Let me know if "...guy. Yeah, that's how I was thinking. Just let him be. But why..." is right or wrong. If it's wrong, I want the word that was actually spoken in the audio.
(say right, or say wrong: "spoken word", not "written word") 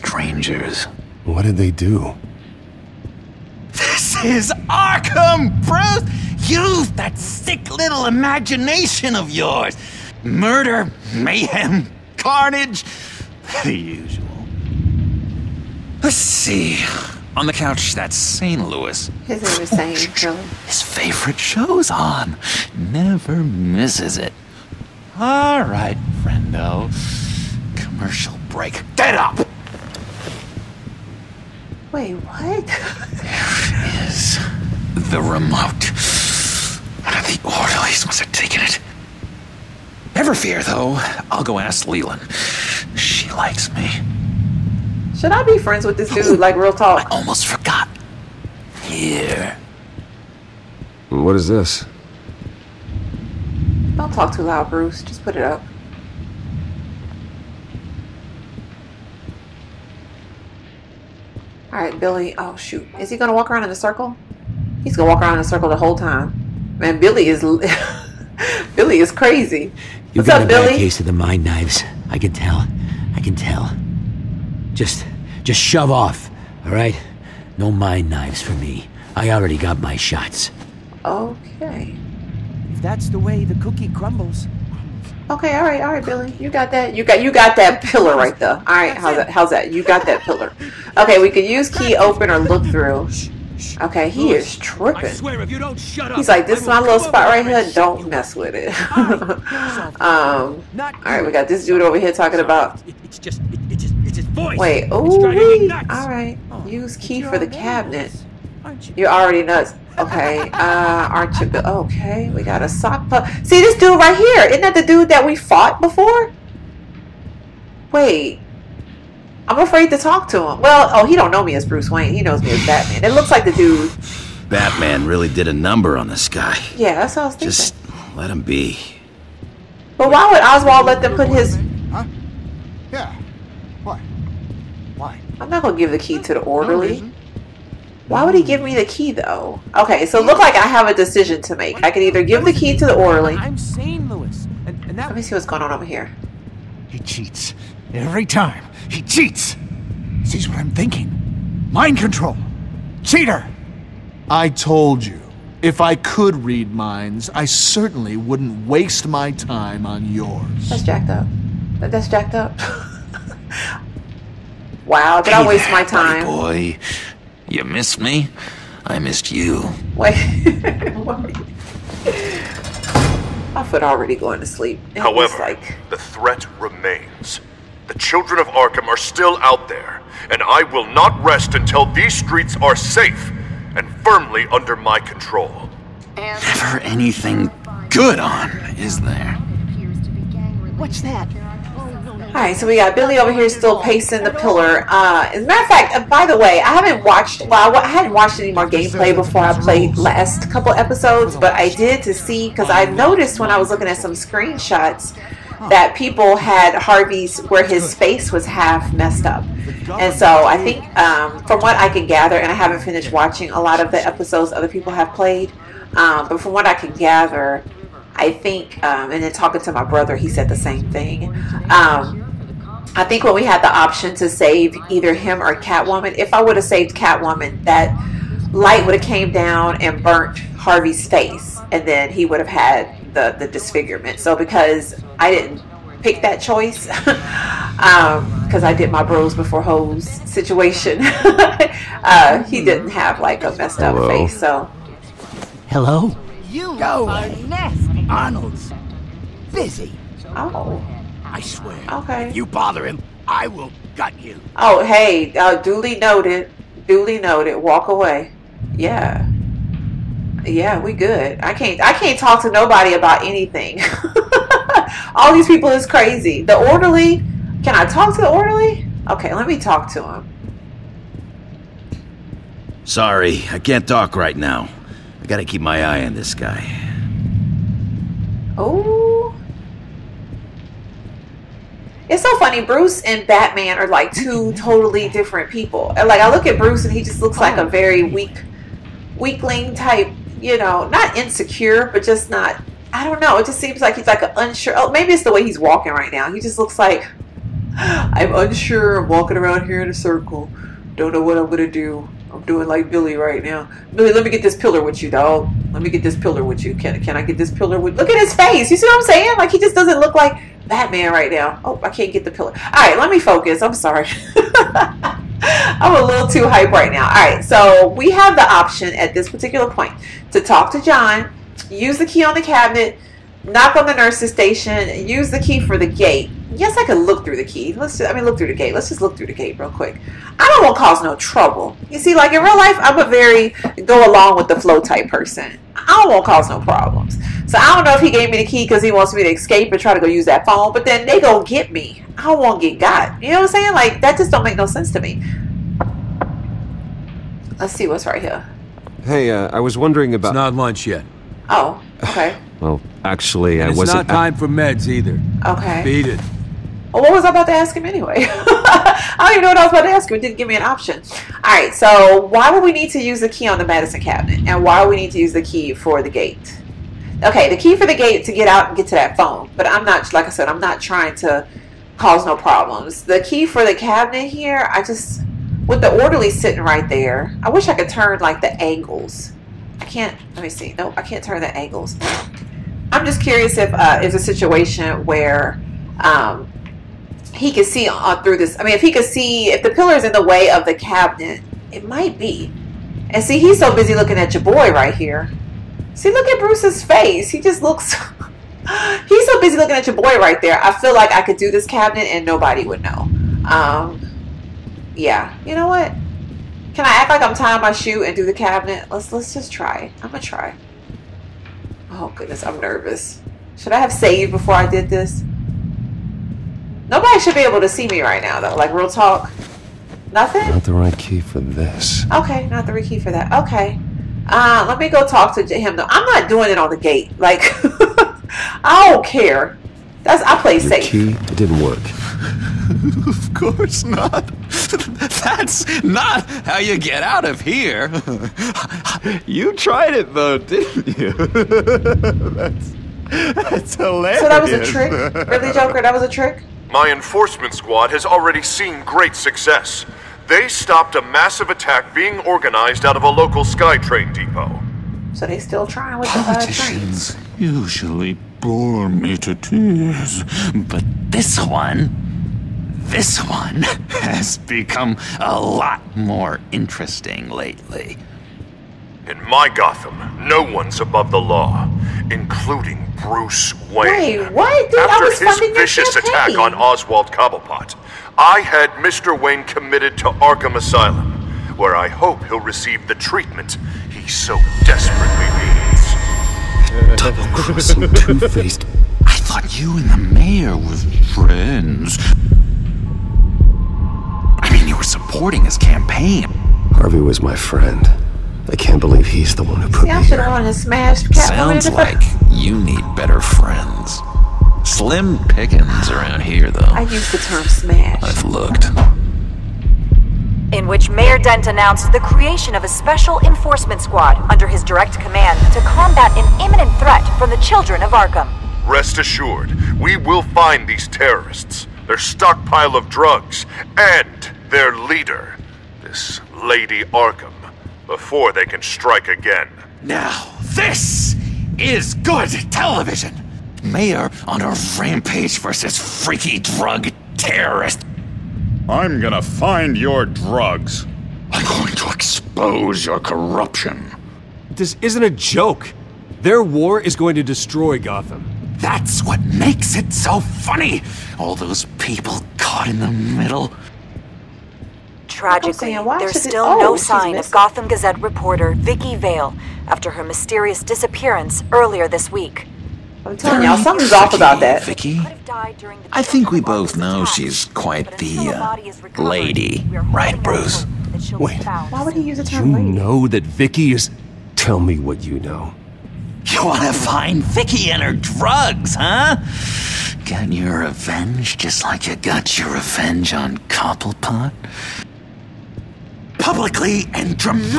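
right.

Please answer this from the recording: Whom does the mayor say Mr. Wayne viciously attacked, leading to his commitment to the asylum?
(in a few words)
Oswald Cobblepot.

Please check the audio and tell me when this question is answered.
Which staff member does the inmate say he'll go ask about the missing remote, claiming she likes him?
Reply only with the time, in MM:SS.
00:41.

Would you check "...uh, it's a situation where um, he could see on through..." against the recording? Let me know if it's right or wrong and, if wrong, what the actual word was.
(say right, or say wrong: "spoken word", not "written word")
right.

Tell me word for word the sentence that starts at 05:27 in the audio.
Let's just, I mean, look through the gate.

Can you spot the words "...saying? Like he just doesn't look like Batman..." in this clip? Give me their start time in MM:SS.
05:09.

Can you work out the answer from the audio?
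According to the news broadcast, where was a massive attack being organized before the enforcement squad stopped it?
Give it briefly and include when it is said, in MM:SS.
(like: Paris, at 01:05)
SkyTrain depot, at 07:33.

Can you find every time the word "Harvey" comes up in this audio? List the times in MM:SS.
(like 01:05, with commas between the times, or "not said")
03:26, 03:50, 08:16.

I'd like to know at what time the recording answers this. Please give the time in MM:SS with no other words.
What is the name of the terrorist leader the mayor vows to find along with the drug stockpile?
08:46.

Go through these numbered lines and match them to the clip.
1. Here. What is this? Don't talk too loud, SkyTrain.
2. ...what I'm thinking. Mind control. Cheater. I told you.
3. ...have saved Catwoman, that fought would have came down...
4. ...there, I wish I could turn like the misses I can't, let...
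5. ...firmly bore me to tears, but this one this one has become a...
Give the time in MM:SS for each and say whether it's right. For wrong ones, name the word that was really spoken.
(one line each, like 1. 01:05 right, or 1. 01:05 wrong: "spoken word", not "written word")
1. 00:48 wrong: "Bruce", not "SkyTrain"
2. 02:30 right
3. 03:46 wrong: "light", not "fought"
4. 06:16 wrong: "angles", not "misses"
5. 07:37 wrong: "usually", not "firmly".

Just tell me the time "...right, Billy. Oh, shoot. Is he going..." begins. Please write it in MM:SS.
01:01.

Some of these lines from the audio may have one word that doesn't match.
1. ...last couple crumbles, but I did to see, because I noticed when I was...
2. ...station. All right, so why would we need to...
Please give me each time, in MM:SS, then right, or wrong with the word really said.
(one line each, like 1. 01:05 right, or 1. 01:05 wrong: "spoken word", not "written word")
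1. 03:19 wrong: "episodes", not "crumbles"
2. 06:00 wrong: "option", not "station".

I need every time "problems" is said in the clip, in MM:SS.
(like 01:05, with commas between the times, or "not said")
05:36, 06:12.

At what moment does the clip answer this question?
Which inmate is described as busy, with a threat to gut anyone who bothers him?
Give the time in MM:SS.
04:08.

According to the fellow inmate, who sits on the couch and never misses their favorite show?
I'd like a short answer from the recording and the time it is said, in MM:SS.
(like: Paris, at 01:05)
St. Louis, at 00:18.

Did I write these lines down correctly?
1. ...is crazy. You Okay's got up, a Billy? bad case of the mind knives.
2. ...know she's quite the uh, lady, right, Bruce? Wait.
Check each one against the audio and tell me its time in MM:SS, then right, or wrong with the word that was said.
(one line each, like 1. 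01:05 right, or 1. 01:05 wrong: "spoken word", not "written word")
1. 01:09 wrong: "What", not "Okay"
2. 09:26 right.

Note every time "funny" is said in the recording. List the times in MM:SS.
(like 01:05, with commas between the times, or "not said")
04:42, 09:10.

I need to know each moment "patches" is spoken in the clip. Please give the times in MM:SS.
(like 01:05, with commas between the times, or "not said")
not said.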